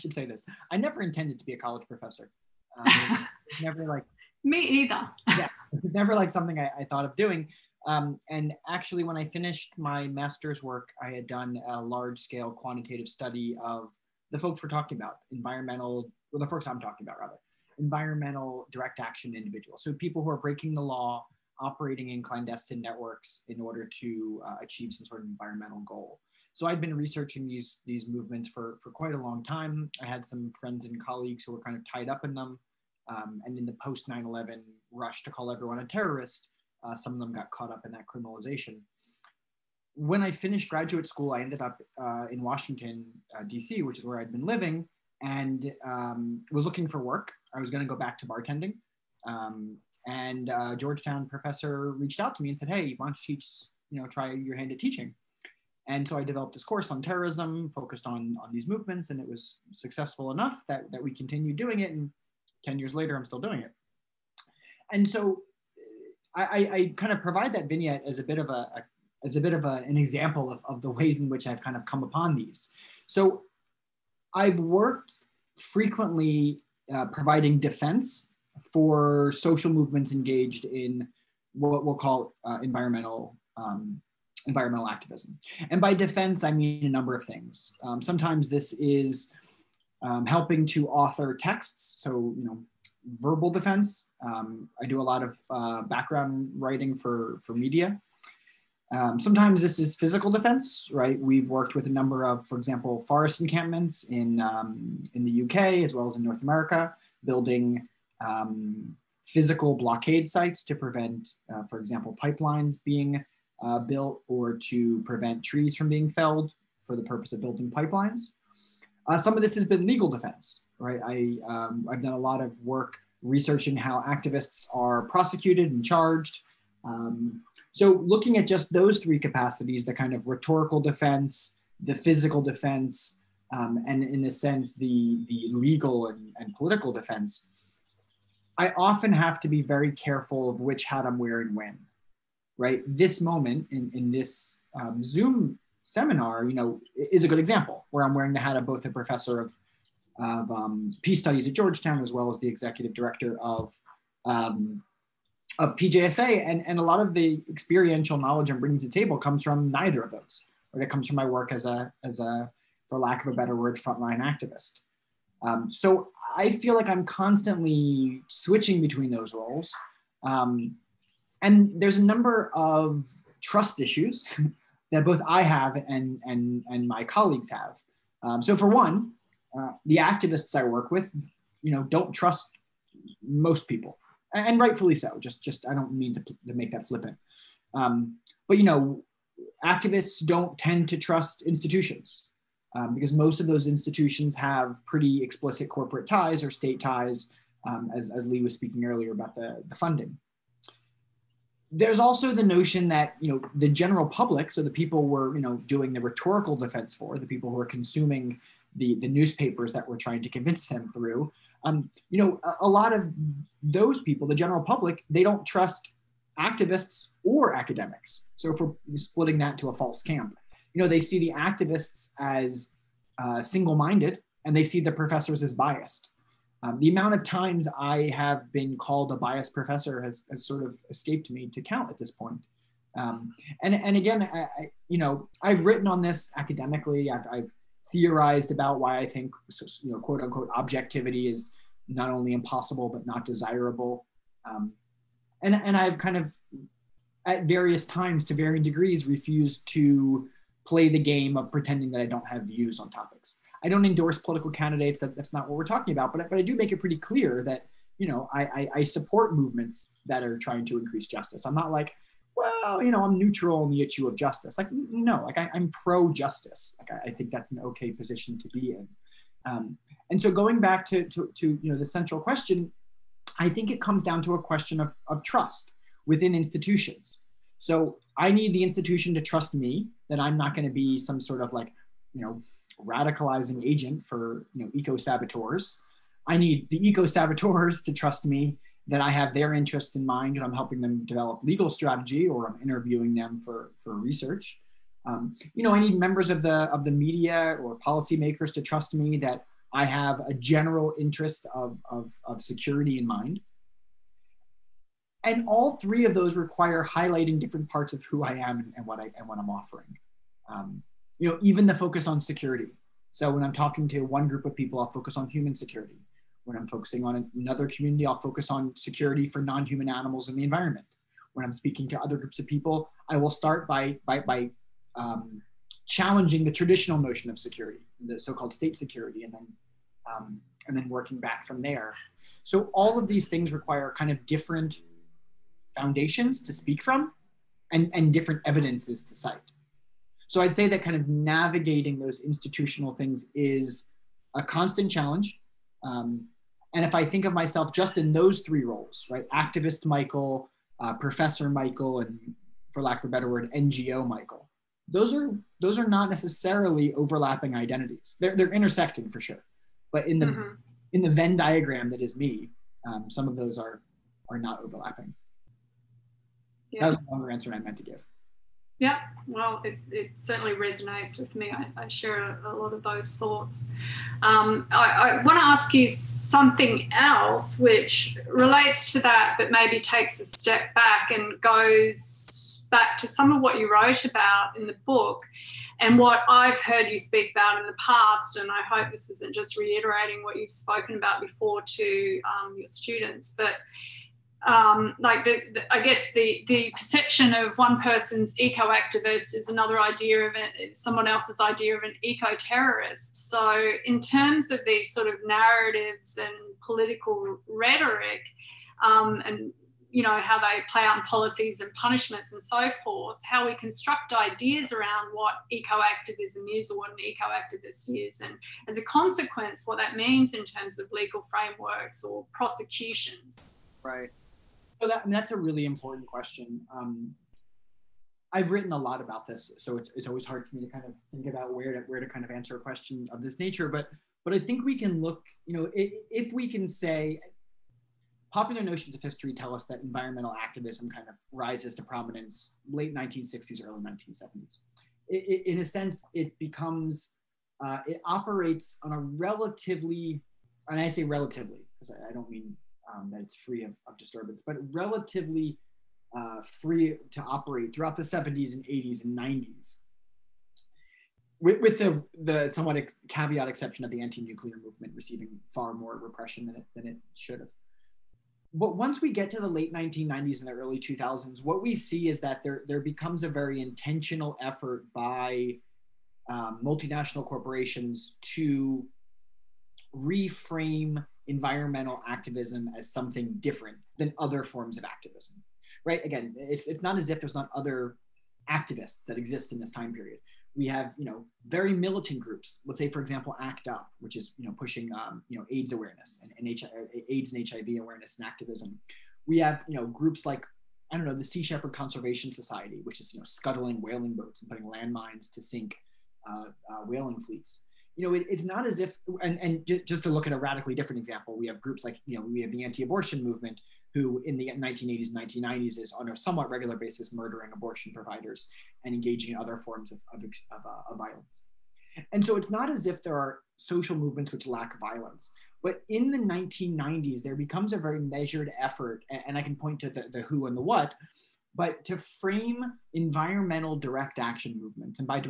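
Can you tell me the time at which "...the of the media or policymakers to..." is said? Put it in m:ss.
4:56.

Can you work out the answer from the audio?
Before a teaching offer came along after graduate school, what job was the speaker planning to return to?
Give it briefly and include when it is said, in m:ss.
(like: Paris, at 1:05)
bartending, at 0:48.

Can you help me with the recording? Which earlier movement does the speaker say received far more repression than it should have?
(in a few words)
anti nuclear movement.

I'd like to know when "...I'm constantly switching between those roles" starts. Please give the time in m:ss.
2:46.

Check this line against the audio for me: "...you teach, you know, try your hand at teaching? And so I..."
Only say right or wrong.
right.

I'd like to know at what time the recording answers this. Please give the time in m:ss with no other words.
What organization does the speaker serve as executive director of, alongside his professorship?
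2:35.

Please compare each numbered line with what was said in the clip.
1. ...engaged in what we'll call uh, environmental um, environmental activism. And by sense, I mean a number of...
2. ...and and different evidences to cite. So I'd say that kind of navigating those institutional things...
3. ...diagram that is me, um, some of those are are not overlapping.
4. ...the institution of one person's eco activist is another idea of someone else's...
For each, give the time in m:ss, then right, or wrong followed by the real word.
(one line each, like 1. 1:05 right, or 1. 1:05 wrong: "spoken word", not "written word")
1. 1:20 wrong: "defense", not "sense"
2. 5:37 right
3. 6:01 right
4. 6:36 wrong: "perception", not "institution".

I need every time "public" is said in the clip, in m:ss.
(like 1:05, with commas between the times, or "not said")
3:24, 3:34.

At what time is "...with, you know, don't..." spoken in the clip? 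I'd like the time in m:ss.
3:00.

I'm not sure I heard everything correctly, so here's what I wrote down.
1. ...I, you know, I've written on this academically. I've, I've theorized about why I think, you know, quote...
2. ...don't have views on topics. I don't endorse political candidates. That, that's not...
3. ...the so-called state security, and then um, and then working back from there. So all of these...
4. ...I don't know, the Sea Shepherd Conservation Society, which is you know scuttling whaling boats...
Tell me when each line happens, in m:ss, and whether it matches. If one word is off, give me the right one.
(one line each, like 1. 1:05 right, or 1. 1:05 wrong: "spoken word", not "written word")
1. 3:54 right
2. 4:12 right
3. 5:28 right
4. 8:20 right.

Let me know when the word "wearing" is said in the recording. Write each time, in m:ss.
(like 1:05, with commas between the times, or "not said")
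2:21, 2:28.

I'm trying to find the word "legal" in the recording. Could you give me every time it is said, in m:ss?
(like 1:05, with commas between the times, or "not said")
1:59, 2:15, 4:51, 7:00.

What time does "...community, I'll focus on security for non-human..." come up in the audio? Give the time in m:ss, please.
5:17.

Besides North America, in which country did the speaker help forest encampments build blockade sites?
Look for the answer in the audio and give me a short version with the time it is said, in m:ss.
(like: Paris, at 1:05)
UK, at 1:45.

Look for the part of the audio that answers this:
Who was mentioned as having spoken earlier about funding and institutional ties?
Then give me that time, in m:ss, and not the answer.
3:18.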